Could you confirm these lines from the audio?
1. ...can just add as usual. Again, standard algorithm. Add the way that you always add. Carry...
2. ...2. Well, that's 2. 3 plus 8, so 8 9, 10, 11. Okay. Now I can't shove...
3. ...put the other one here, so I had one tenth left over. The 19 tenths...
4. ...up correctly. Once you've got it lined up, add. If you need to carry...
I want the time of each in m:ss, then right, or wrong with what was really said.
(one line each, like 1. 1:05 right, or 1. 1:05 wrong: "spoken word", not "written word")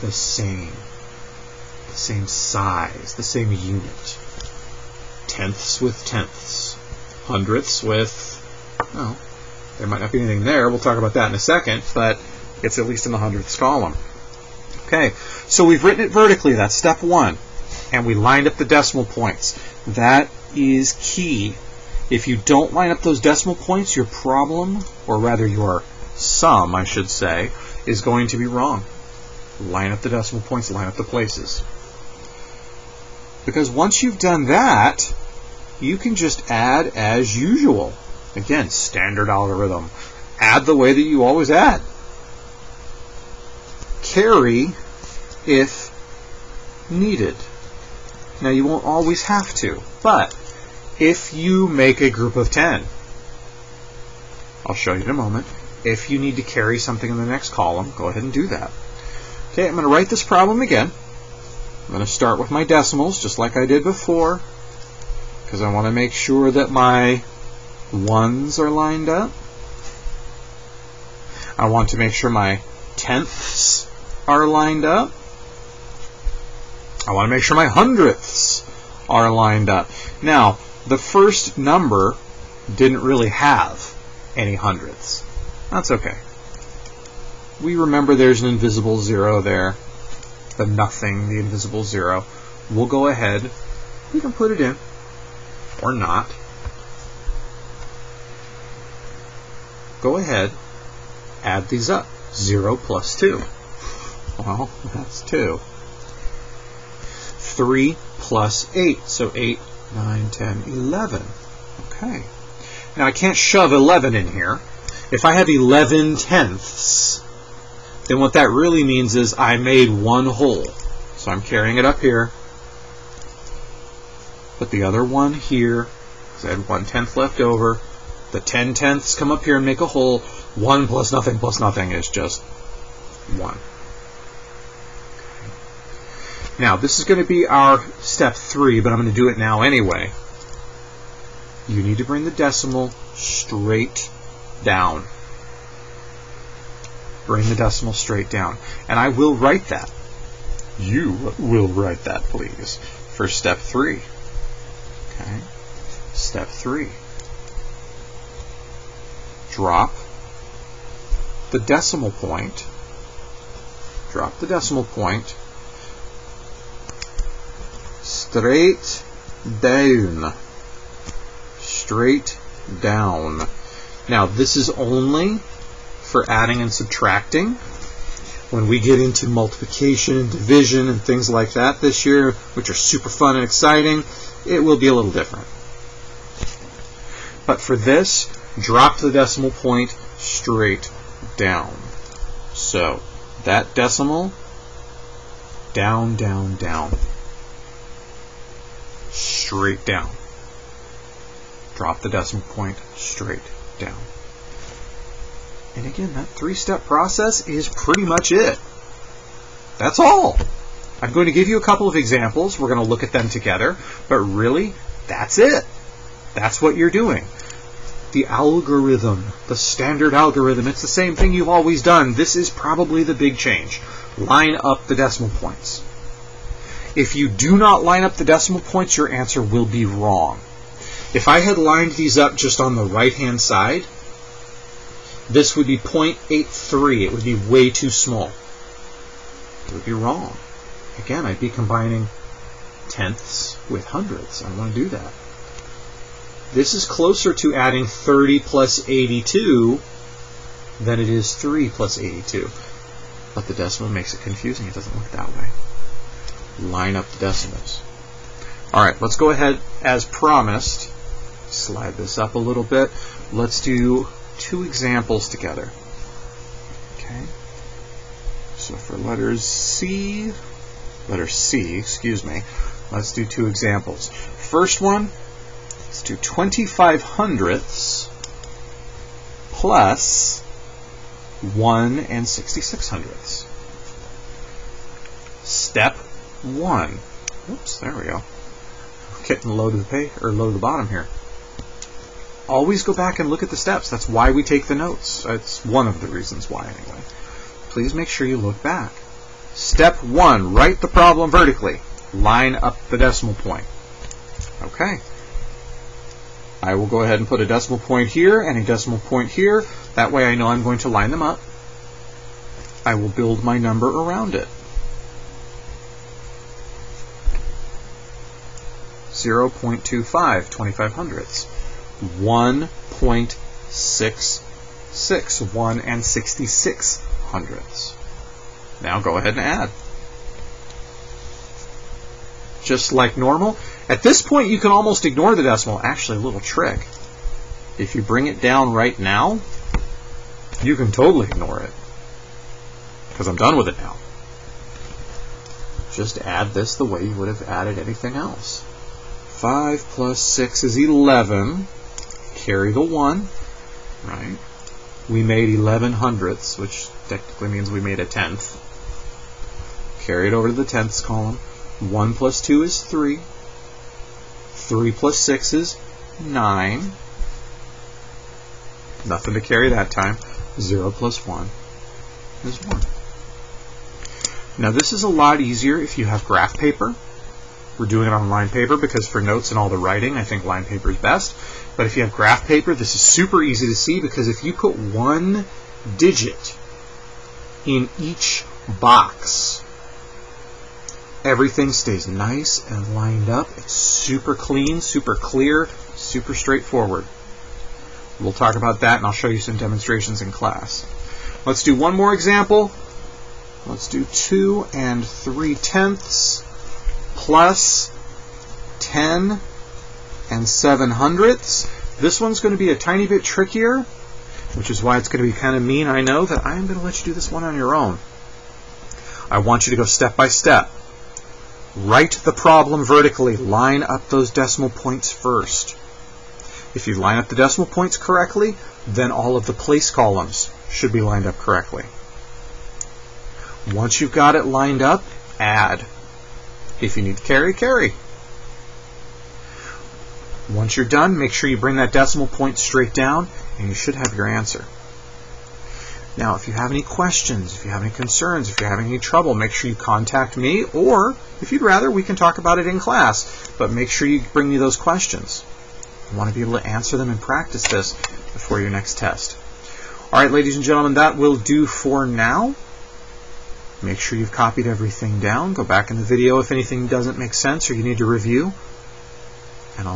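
1. 0:35 right
2. 1:43 right
3. 2:04 wrong: "10", not "19"
4. 7:11 right.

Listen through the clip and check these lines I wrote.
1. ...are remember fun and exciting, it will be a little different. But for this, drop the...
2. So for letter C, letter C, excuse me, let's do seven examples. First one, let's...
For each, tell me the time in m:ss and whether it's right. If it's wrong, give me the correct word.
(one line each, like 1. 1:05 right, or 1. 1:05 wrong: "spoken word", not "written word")
1. 3:02 wrong: "super", not "remember"
2. 4:28 wrong: "two", not "seven".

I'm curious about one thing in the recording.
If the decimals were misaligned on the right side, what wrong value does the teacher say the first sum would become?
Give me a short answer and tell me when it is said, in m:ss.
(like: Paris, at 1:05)
0.83, at 3:55.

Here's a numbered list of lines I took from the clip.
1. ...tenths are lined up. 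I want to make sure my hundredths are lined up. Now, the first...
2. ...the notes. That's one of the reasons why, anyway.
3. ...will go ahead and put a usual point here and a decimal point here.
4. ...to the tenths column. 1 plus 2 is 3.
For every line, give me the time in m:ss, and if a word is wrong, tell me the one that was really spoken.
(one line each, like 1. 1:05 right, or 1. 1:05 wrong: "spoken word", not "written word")
1. 1:12 right
2. 4:54 right
3. 5:06 wrong: "decimal", not "usual"
4. 6:00 right.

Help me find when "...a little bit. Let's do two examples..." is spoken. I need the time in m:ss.
4:22.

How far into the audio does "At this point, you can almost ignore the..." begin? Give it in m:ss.
5:33.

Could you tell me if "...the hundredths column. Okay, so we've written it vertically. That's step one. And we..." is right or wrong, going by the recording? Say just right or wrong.
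right.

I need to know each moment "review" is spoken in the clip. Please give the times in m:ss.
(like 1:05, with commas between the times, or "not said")
7:48.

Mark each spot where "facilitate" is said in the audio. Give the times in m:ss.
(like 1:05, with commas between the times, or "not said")
not said.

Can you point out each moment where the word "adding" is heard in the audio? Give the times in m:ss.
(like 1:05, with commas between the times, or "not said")
2:56, 4:07.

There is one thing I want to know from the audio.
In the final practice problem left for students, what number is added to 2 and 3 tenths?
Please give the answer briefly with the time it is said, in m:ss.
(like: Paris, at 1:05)
10.07, at 6:48.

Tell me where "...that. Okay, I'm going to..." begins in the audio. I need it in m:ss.
0:58.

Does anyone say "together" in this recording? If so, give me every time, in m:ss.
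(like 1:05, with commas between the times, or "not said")
3:33, 4:25.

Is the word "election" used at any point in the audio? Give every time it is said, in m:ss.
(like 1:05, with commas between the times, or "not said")
not said.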